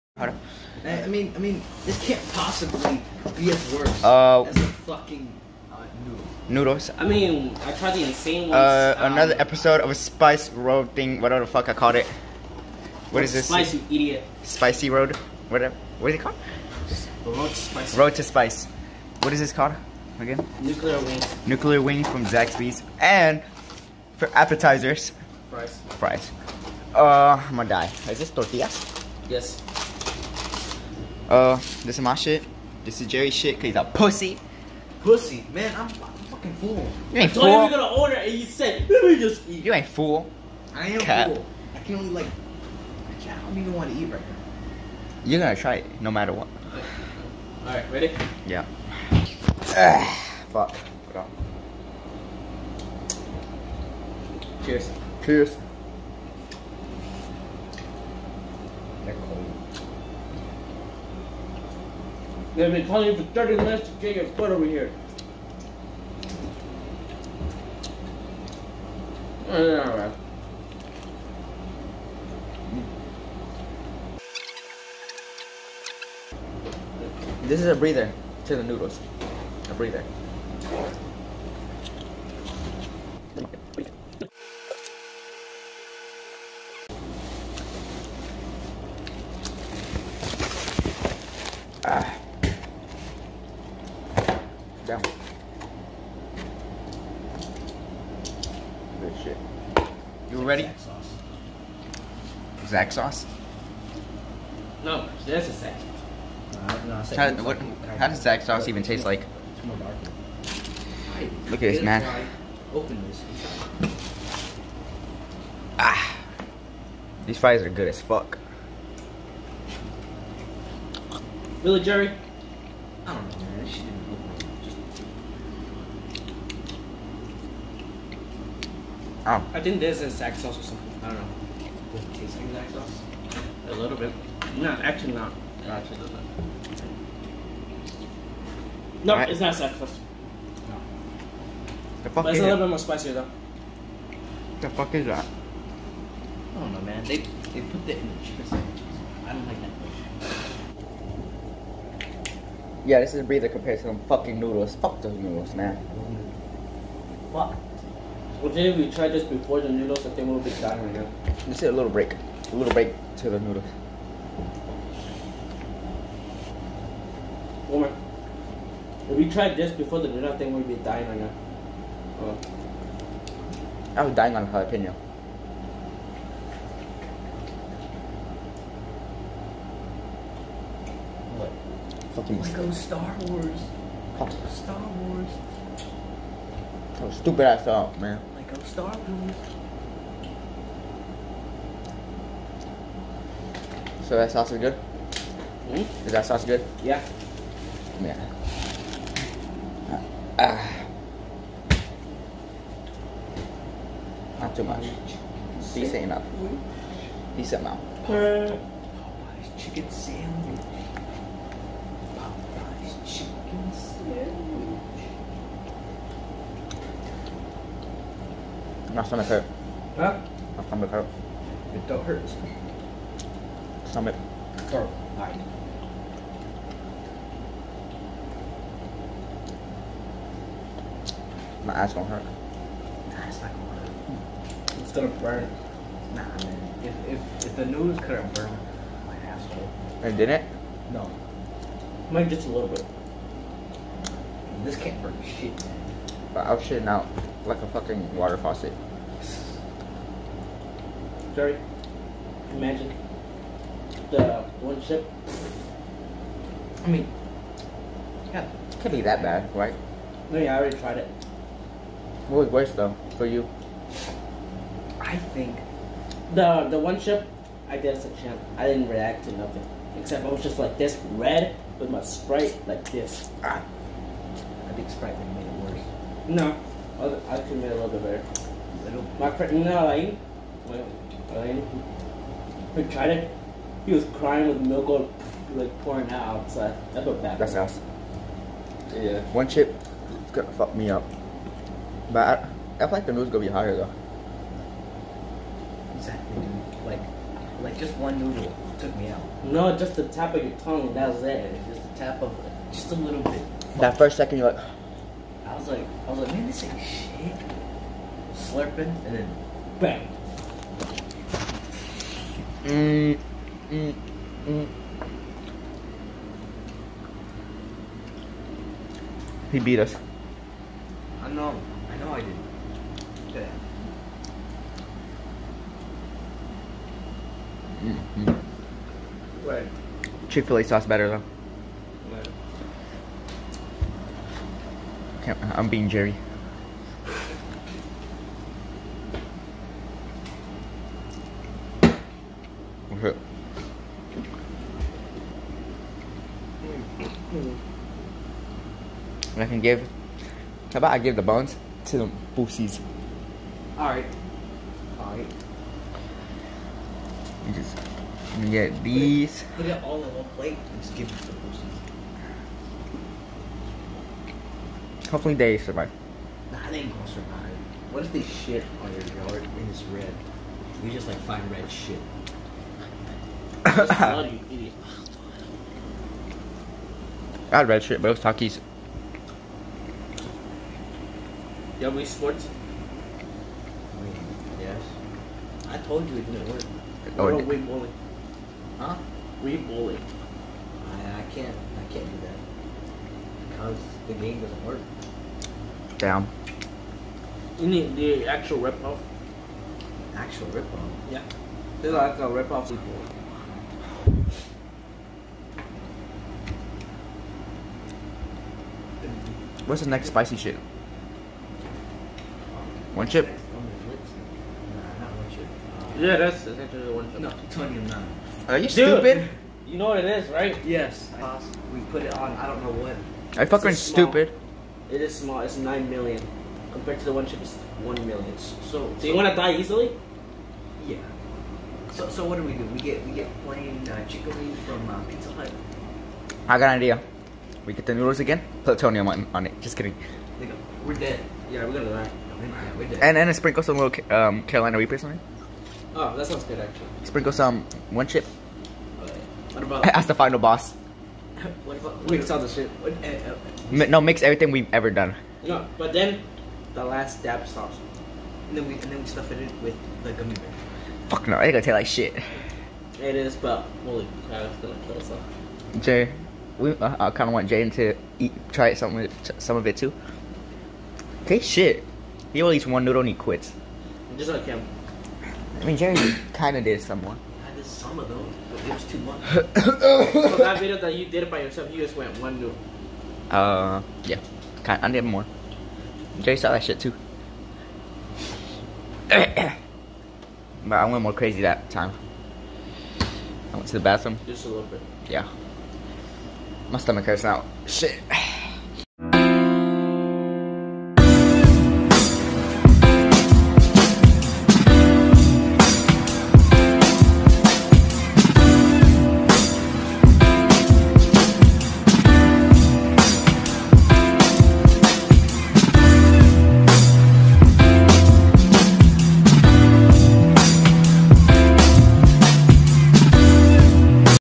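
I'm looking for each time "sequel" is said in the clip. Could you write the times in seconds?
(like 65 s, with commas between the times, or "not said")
402 s.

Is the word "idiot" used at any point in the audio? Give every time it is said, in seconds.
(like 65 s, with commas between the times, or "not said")
13 s, 374 s.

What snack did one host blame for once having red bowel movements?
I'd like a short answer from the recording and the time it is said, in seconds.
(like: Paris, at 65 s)
Takis, at 378 s.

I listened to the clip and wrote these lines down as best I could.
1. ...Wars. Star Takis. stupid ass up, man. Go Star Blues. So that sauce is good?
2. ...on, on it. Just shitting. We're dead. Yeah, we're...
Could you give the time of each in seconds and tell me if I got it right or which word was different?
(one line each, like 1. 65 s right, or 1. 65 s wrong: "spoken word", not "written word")
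1. 183 s wrong: "Wars", not "Takis"
2. 439 s wrong: "kidding", not "shitting".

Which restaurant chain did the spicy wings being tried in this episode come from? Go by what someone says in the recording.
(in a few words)
Zaxby's.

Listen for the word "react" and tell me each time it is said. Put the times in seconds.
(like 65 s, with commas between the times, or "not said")
268 s.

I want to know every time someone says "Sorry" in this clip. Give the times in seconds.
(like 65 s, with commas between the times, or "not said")
251 s.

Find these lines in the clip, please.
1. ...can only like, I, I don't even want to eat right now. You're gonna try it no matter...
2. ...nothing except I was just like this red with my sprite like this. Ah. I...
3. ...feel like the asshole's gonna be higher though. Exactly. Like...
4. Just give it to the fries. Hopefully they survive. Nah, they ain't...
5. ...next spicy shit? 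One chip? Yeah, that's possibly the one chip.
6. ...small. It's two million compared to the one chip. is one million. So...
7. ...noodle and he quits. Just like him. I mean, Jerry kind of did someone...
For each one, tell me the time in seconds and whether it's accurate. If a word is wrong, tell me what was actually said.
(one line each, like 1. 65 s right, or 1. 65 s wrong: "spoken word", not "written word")
1. 41 s right
2. 269 s right
3. 292 s wrong: "noodle", not "asshole"
4. 360 s wrong: "pussies", not "fries"
5. 409 s wrong: "essentially", not "possibly"
6. 425 s wrong: "nine", not "two"
7. 472 s right.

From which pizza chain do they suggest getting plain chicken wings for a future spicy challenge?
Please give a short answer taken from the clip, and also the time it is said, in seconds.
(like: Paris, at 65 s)
Pizza Hut, at 435 s.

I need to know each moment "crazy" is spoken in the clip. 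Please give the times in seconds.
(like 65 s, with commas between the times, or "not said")
491 s.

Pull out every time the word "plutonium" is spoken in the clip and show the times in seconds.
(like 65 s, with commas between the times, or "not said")
438 s.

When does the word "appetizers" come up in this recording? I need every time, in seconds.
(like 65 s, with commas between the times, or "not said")
24 s.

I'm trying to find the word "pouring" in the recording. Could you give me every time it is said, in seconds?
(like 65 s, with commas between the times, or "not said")
285 s.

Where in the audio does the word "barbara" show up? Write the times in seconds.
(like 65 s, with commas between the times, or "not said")
not said.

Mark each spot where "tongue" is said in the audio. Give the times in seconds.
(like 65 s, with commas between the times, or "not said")
300 s.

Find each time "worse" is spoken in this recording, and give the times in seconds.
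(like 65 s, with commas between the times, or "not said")
3 s, 262 s, 275 s.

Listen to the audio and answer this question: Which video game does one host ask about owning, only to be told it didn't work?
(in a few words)
Wii Sports.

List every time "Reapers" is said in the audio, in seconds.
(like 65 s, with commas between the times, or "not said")
444 s.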